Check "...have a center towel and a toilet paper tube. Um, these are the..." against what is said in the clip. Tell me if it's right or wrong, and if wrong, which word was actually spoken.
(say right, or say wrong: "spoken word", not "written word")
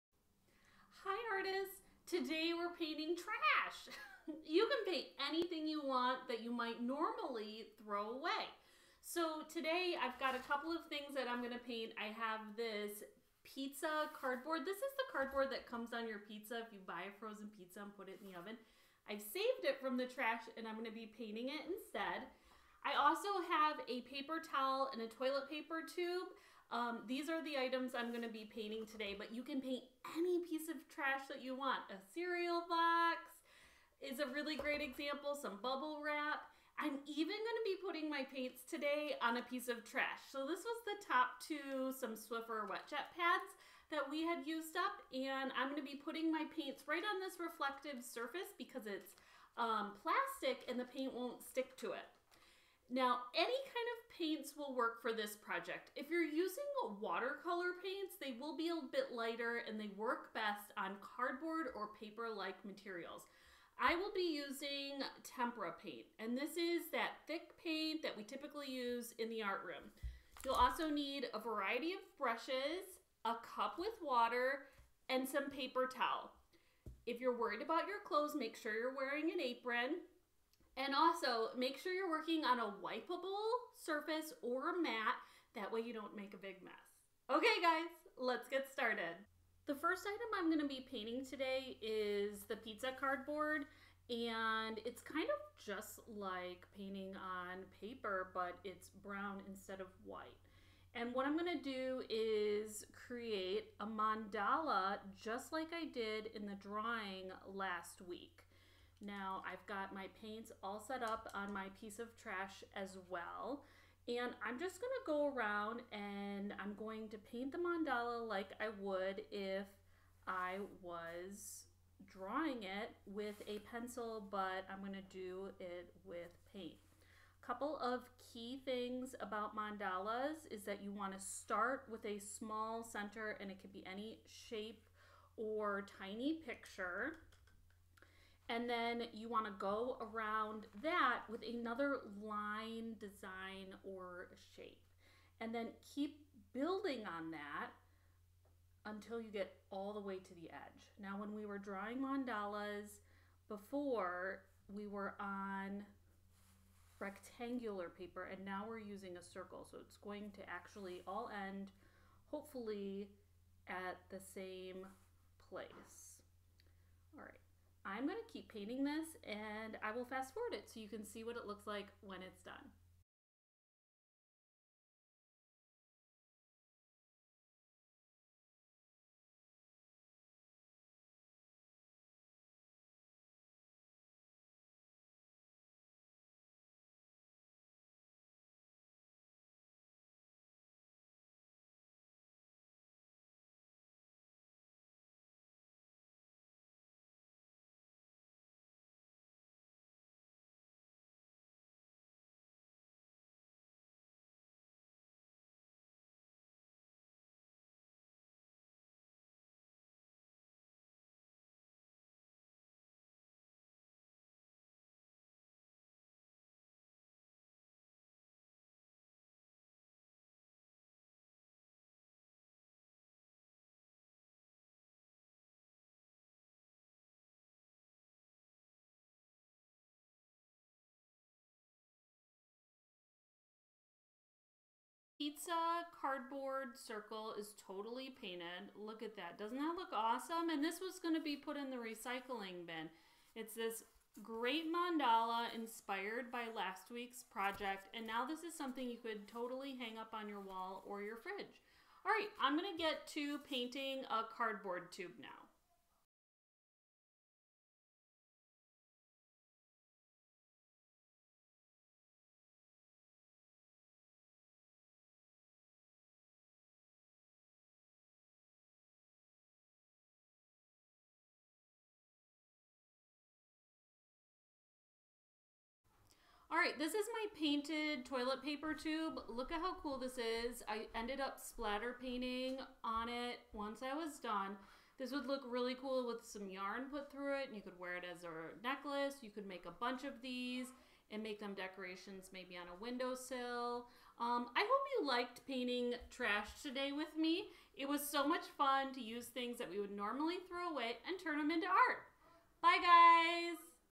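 wrong: "paper", not "center".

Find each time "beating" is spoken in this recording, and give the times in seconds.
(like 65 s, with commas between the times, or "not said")
not said.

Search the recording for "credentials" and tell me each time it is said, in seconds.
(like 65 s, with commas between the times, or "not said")
not said.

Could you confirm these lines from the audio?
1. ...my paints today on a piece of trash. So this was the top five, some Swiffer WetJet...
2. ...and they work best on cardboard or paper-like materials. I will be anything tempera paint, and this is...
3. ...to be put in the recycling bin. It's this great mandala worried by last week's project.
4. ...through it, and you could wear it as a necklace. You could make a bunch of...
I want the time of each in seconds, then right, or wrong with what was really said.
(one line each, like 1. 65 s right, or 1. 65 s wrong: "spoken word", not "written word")
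1. 38 s wrong: "two", not "five"
2. 59 s wrong: "using", not "anything"
3. 241 s wrong: "inspired", not "worried"
4. 287 s right.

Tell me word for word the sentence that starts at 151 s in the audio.
Now, when we were drawing mandalas before, we were on rectangular paper and now we're using a circle.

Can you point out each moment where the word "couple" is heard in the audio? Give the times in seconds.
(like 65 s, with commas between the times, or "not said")
10 s, 127 s.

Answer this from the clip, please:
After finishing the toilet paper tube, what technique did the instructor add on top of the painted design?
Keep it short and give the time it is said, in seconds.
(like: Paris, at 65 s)
splatter painting, at 281 s.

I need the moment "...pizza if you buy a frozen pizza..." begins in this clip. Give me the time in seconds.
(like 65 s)
16 s.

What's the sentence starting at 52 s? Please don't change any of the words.
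Now, any kind of paints will work for this project.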